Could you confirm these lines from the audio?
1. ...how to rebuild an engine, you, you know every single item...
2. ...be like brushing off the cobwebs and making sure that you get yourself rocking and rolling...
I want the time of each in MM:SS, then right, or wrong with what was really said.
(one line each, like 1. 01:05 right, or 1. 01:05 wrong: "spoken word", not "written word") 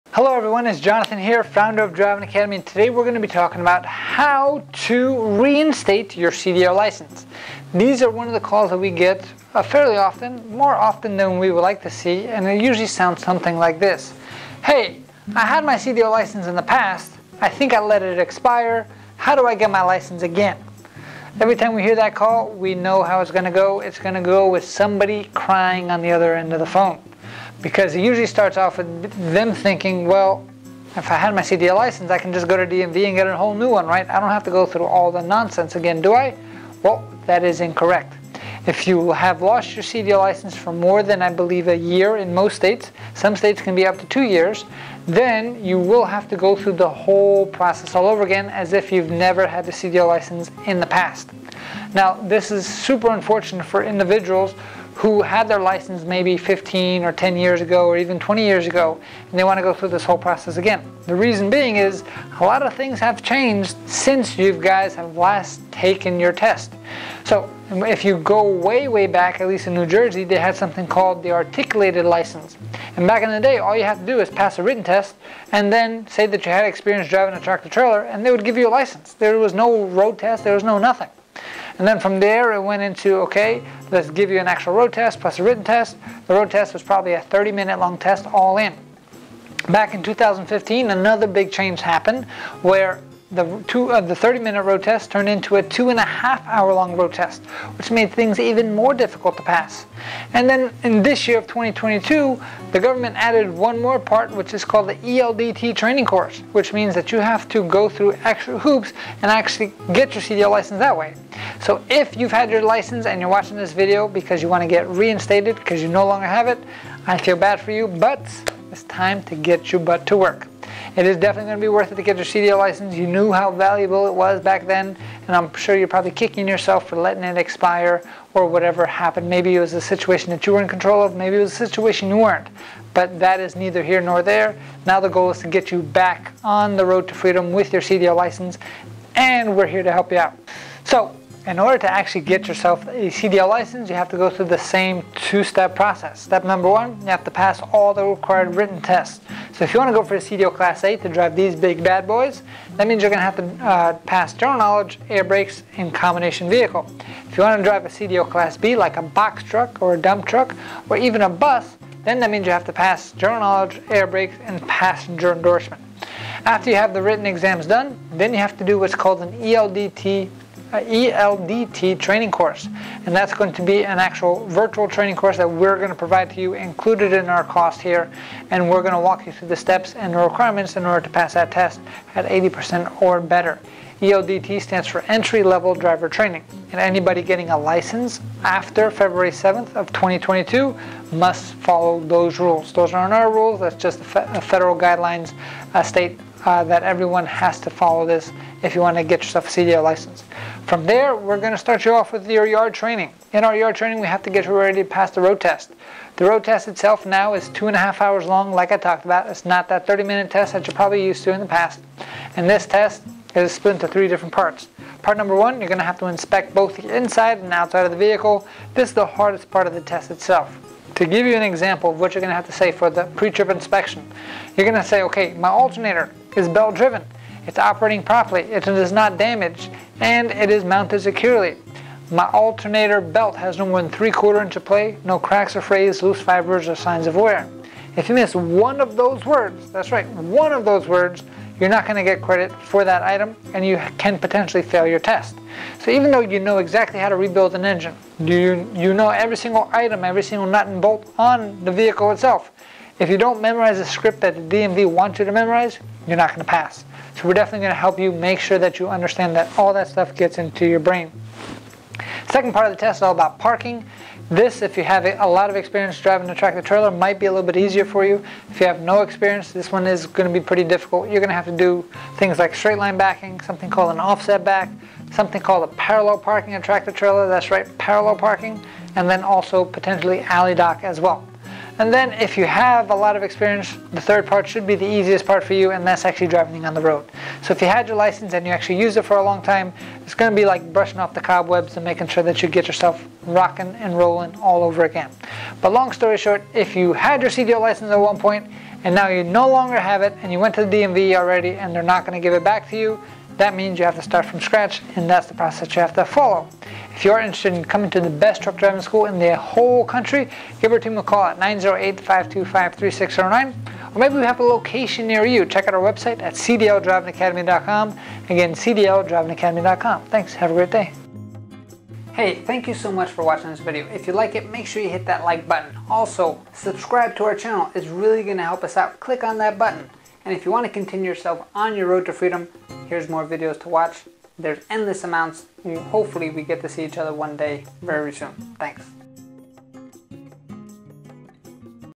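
1. 04:06 right
2. 04:50 right.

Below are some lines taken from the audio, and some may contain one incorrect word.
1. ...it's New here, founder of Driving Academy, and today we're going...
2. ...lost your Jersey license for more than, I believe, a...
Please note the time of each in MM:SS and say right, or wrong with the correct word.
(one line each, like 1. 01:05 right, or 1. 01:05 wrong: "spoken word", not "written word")
1. 00:00 wrong: "Jonathan", not "New"
2. 00:39 wrong: "CDL", not "Jersey".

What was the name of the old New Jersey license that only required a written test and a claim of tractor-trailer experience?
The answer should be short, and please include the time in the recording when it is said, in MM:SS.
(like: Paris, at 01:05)
articulated license, at 01:11.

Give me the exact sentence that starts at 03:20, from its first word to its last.
From there, we're going to start you off with your yard training.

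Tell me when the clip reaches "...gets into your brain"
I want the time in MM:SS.
04:20.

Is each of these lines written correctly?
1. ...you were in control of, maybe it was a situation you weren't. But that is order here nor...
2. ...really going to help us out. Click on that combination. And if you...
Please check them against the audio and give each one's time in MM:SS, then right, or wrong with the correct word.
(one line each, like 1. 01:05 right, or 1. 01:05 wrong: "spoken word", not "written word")
1. 02:10 wrong: "neither", not "order"
2. 05:27 wrong: "button", not "combination".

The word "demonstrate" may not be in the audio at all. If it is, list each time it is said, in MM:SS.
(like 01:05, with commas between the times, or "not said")
not said.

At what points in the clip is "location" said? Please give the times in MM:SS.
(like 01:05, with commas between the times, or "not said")
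05:14.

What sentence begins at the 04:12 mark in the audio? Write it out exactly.
If you don't memorize the script that the DMV wants you to memorize, you're not going to pass.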